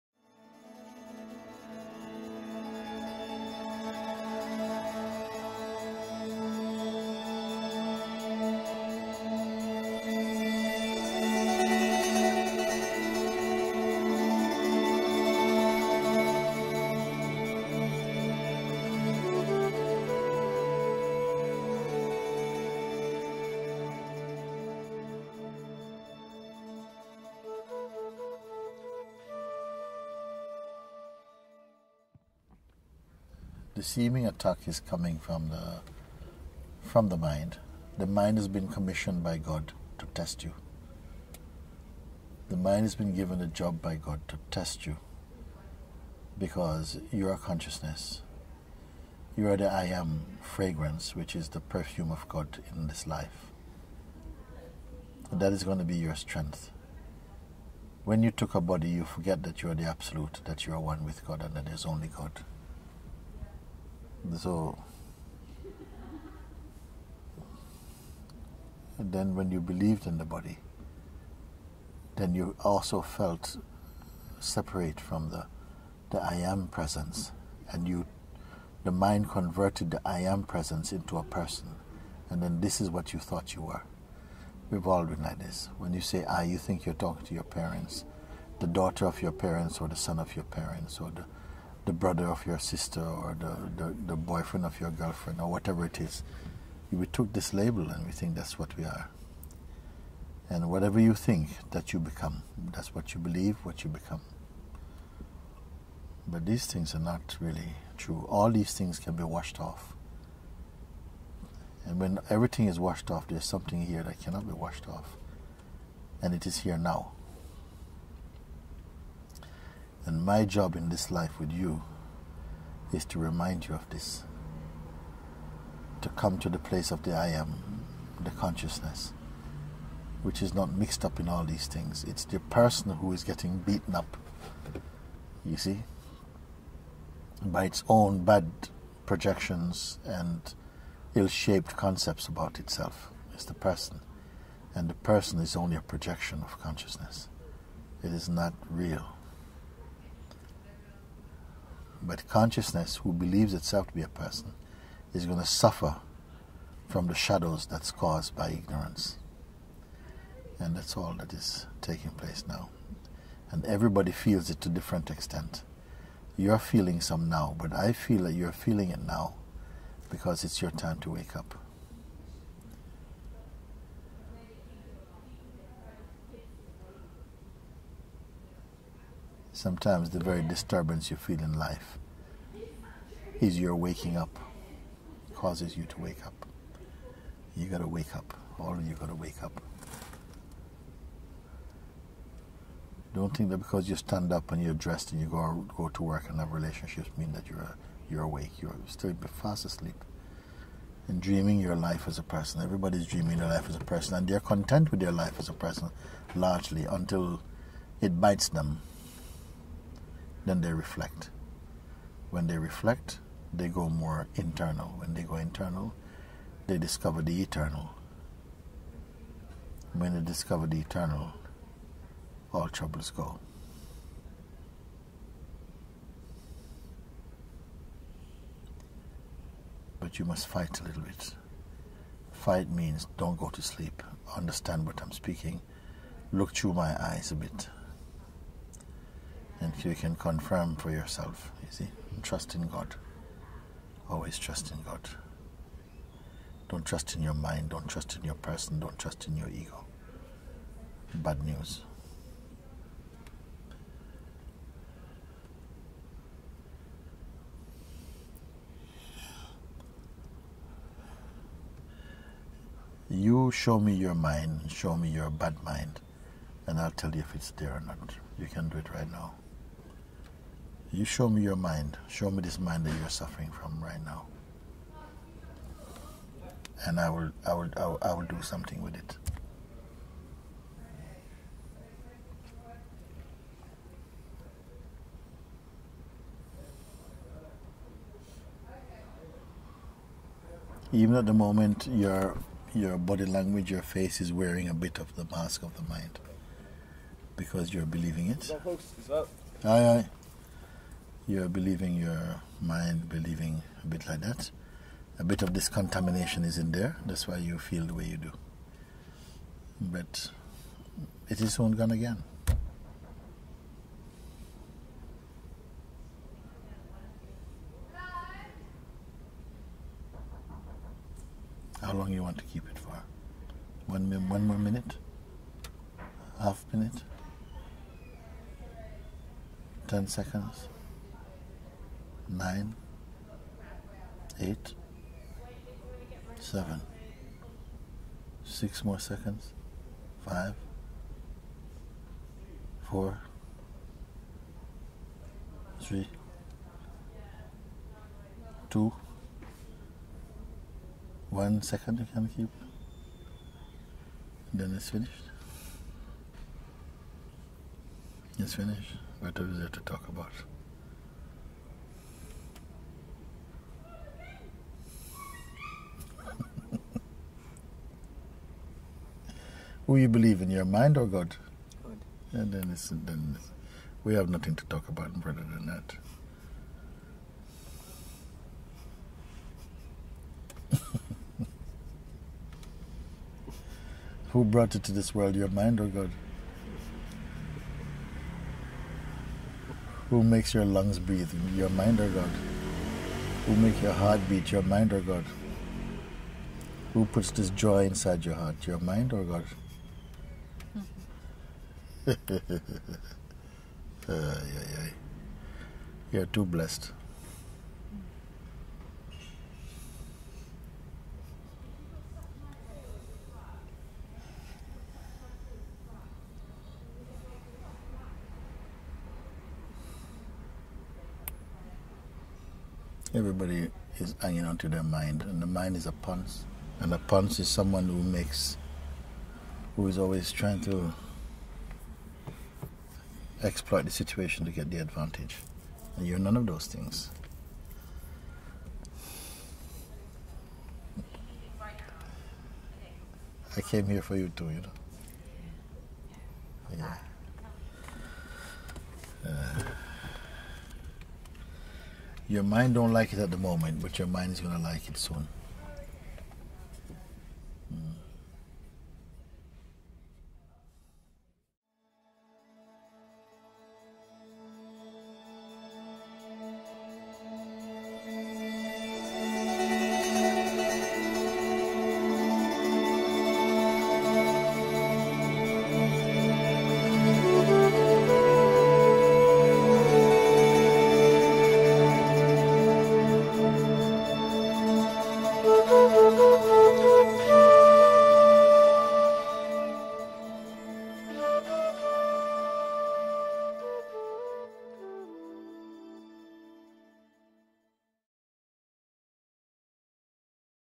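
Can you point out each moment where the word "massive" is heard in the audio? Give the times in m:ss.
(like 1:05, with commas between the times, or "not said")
not said.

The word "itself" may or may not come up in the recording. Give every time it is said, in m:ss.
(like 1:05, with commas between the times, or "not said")
2:22, 2:33.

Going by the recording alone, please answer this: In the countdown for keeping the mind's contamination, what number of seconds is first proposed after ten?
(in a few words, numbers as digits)
9.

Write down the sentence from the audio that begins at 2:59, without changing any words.
Sometimes the very disturbance you feel in life is your waking up, causes you to wake up.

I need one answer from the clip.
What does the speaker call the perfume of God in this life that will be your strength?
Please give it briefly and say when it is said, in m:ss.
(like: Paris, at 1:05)
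The I am fragrance, at 0:49.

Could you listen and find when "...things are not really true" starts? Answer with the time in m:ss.
1:46.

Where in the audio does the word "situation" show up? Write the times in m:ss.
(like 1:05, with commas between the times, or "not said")
7:13.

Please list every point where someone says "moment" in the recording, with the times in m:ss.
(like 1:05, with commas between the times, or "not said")
4:51, 7:33.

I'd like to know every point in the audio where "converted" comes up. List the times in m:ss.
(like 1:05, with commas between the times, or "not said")
1:19.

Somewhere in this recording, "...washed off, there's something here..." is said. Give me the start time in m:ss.
1:52.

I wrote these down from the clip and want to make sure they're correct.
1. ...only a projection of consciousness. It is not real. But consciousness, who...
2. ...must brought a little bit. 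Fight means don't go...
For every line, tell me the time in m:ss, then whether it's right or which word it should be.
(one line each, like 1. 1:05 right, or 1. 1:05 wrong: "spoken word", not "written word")
1. 2:25 right
2. 3:50 wrong: "fight", not "brought".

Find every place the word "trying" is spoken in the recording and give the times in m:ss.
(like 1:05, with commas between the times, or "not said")
7:10.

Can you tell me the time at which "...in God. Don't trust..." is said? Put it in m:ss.
4:04.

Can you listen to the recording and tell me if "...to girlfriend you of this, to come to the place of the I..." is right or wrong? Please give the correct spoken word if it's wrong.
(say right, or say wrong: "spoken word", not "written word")
wrong: "remind", not "girlfriend".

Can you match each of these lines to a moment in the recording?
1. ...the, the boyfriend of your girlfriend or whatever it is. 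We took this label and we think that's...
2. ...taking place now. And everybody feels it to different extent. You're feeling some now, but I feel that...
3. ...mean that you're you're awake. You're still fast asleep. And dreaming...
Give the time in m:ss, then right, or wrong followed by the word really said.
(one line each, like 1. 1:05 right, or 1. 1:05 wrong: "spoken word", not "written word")
1. 1:33 right
2. 2:41 right
3. 3:17 right.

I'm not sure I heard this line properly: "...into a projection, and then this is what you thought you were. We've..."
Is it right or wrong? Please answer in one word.
wrong.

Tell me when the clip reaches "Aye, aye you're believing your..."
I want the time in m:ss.
4:59.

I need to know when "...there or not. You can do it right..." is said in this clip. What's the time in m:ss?
4:27.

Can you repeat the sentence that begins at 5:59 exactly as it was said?
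What is there to talk about?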